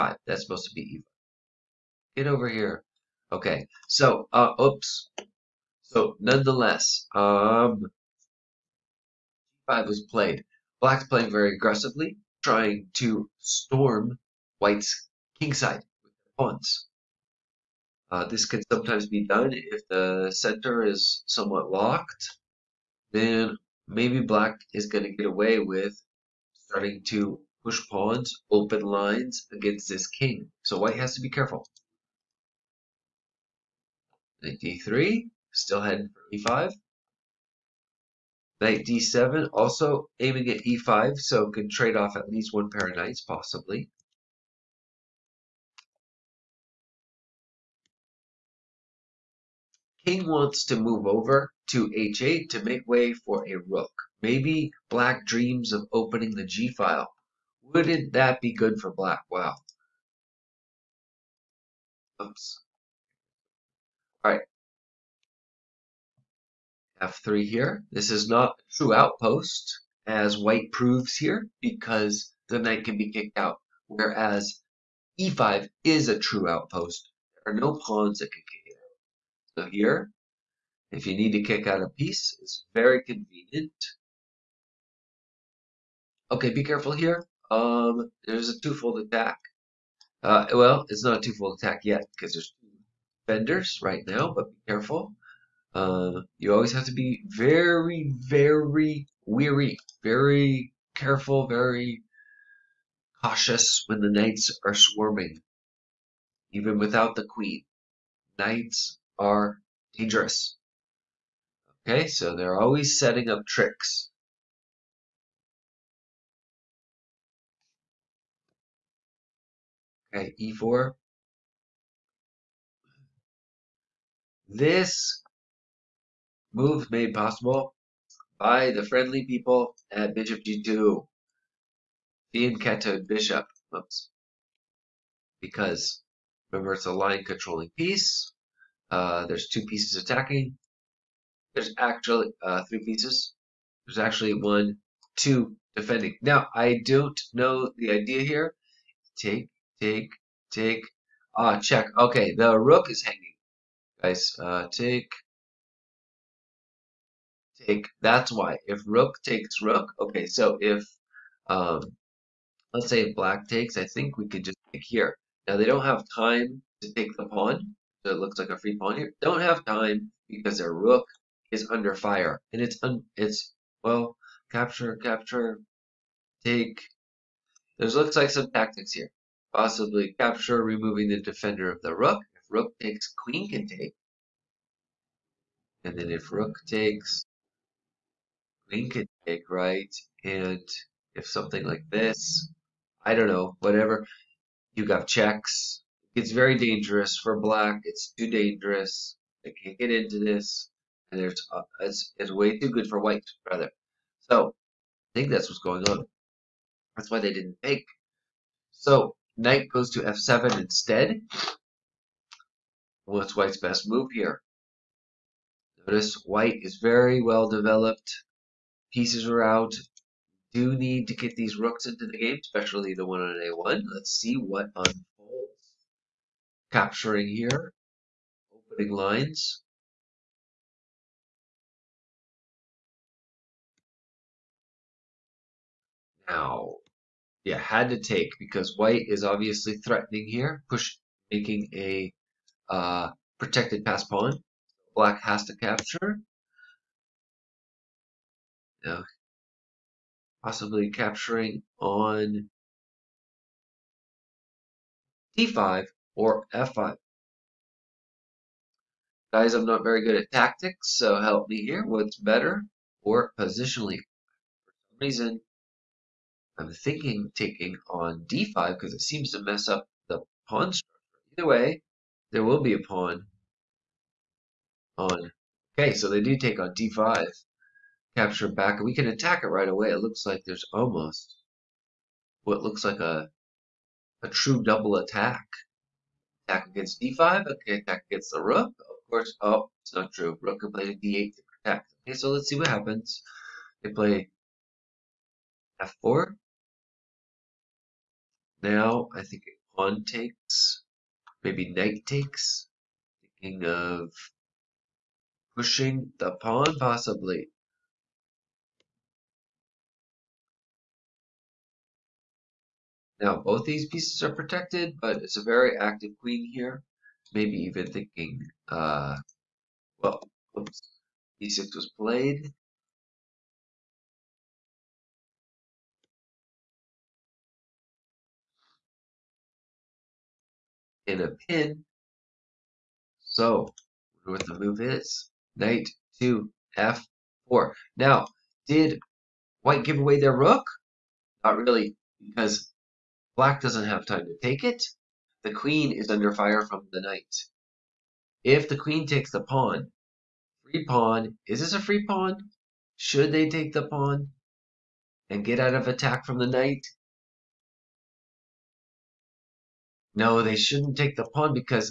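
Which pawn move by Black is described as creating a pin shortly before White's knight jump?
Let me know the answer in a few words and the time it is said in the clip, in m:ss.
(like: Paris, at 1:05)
e6, at 5:21.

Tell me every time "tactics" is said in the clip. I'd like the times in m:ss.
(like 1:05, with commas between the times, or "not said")
2:58, 4:20.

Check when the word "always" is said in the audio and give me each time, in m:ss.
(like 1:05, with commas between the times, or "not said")
1:36, 1:52.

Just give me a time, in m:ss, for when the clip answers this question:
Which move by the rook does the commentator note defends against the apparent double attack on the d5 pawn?
4:50.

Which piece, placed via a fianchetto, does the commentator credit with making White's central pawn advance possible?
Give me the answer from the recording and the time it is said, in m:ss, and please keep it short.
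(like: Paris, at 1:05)
Bishop g2, at 2:10.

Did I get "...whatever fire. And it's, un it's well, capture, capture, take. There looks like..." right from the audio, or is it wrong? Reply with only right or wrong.
wrong.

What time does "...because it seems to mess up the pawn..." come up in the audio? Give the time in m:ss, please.
4:28.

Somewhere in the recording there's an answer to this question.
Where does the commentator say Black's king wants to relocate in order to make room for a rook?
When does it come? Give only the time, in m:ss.
0:51.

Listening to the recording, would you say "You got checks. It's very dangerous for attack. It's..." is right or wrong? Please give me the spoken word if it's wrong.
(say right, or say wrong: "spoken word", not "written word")
wrong: "black", not "attack".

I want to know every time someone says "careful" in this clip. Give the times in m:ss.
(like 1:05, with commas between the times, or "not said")
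0:31, 1:26, 1:34, 1:40.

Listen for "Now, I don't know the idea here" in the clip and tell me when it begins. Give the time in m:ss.
2:26.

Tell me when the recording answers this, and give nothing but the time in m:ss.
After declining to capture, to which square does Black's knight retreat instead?
3:30.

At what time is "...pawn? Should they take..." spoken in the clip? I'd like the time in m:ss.
5:52.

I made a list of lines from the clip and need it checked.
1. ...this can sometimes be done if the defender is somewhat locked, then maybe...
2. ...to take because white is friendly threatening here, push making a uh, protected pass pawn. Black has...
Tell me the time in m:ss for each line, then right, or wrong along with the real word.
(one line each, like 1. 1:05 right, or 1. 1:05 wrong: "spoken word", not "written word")
1. 0:18 wrong: "center", not "defender"
2. 3:57 wrong: "obviously", not "friendly".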